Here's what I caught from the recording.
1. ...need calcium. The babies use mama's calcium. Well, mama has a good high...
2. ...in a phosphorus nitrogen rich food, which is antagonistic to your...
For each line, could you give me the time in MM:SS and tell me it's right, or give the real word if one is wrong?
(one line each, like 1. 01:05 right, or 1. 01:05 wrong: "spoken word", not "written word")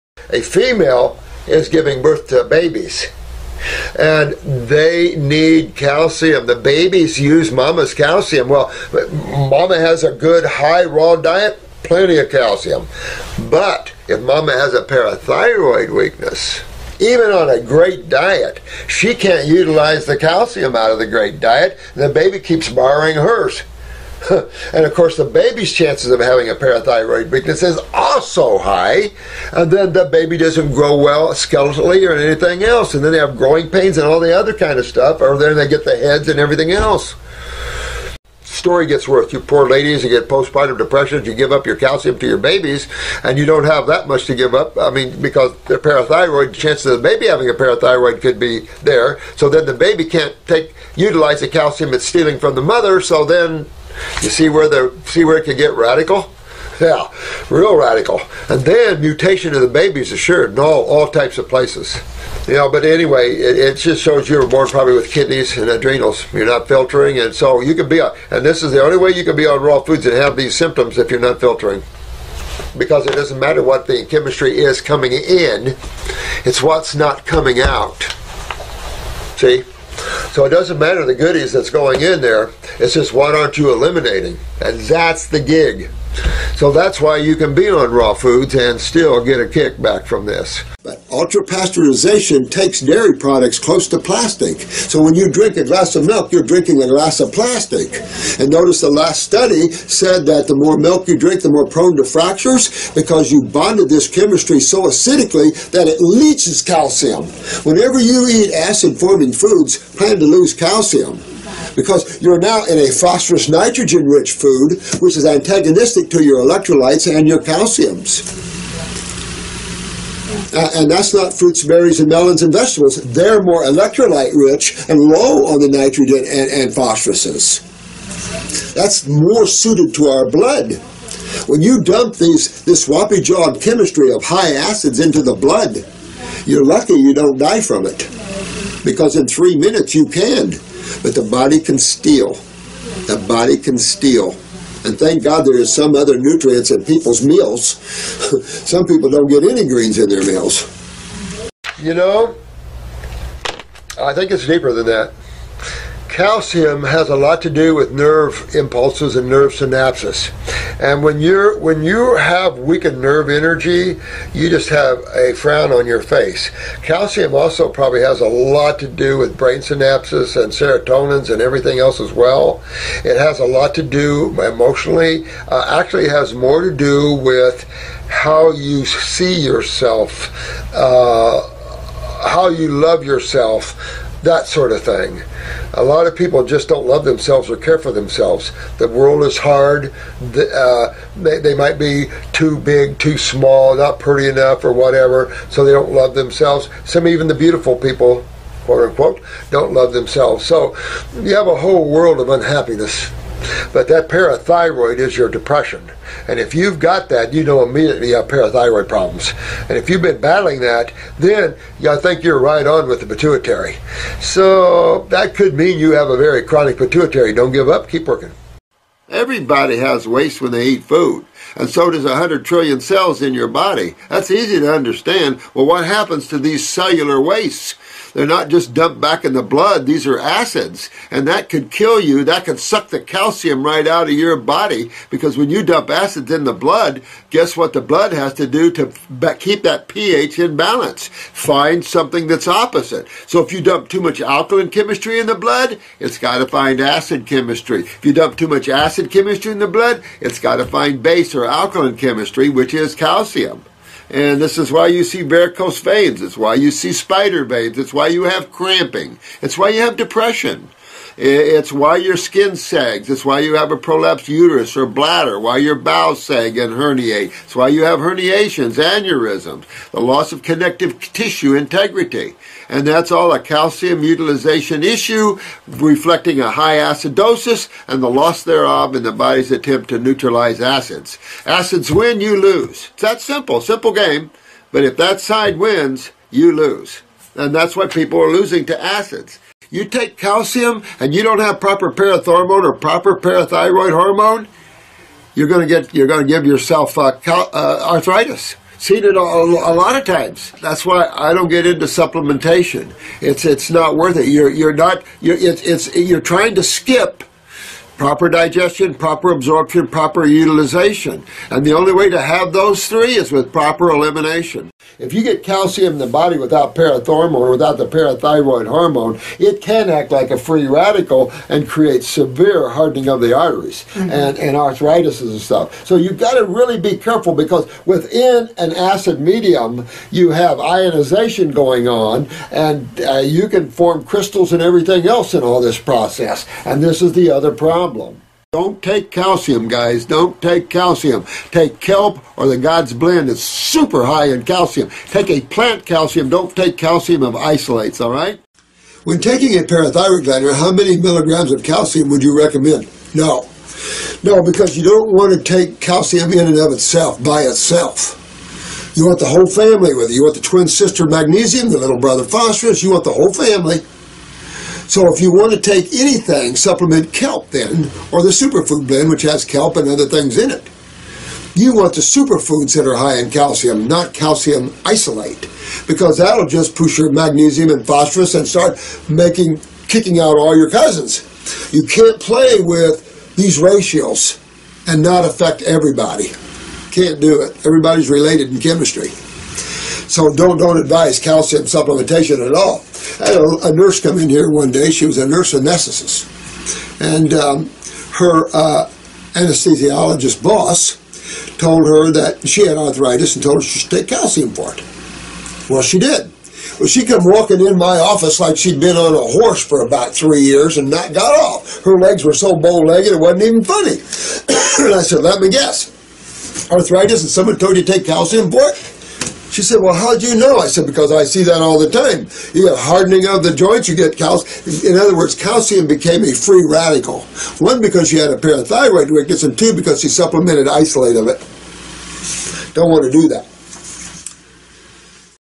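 1. 00:05 right
2. 01:52 right.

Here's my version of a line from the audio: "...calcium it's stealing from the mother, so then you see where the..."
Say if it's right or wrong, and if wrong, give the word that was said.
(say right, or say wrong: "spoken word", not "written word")
right.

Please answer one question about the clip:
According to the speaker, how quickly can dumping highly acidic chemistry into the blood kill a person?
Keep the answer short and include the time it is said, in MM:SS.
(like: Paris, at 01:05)
3 minutes, at 02:19.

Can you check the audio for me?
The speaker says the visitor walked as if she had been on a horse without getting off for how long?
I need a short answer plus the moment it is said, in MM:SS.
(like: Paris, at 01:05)
3 years, at 06:50.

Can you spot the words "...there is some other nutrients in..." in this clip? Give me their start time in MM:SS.
02:25.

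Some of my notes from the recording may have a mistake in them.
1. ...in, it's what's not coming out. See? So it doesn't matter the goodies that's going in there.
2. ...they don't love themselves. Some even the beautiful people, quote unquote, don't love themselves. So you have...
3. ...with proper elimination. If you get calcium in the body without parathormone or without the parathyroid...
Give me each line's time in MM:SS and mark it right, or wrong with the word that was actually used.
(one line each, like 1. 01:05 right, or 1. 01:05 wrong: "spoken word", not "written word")
1. 01:15 right
2. 03:15 right
3. 05:13 right.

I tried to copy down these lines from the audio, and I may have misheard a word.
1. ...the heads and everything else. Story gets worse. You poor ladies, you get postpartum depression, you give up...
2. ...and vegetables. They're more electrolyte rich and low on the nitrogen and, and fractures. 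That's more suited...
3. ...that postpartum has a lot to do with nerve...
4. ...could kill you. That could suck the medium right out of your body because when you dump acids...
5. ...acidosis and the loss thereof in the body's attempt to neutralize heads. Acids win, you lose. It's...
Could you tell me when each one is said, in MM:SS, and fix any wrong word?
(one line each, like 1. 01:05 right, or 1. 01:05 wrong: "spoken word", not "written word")
1. 00:35 right
2. 02:02 wrong: "phosphoruses", not "fractures"
3. 02:34 wrong: "calcium", not "postpartum"
4. 03:51 wrong: "calcium", not "medium"
5. 04:36 wrong: "acids", not "heads".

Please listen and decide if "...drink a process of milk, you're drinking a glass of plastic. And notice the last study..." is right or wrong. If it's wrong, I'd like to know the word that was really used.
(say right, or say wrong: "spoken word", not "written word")
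wrong: "glass", not "process".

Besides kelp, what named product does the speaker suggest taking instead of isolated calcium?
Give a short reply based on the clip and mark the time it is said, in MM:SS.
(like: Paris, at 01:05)
God's Blend, at 05:42.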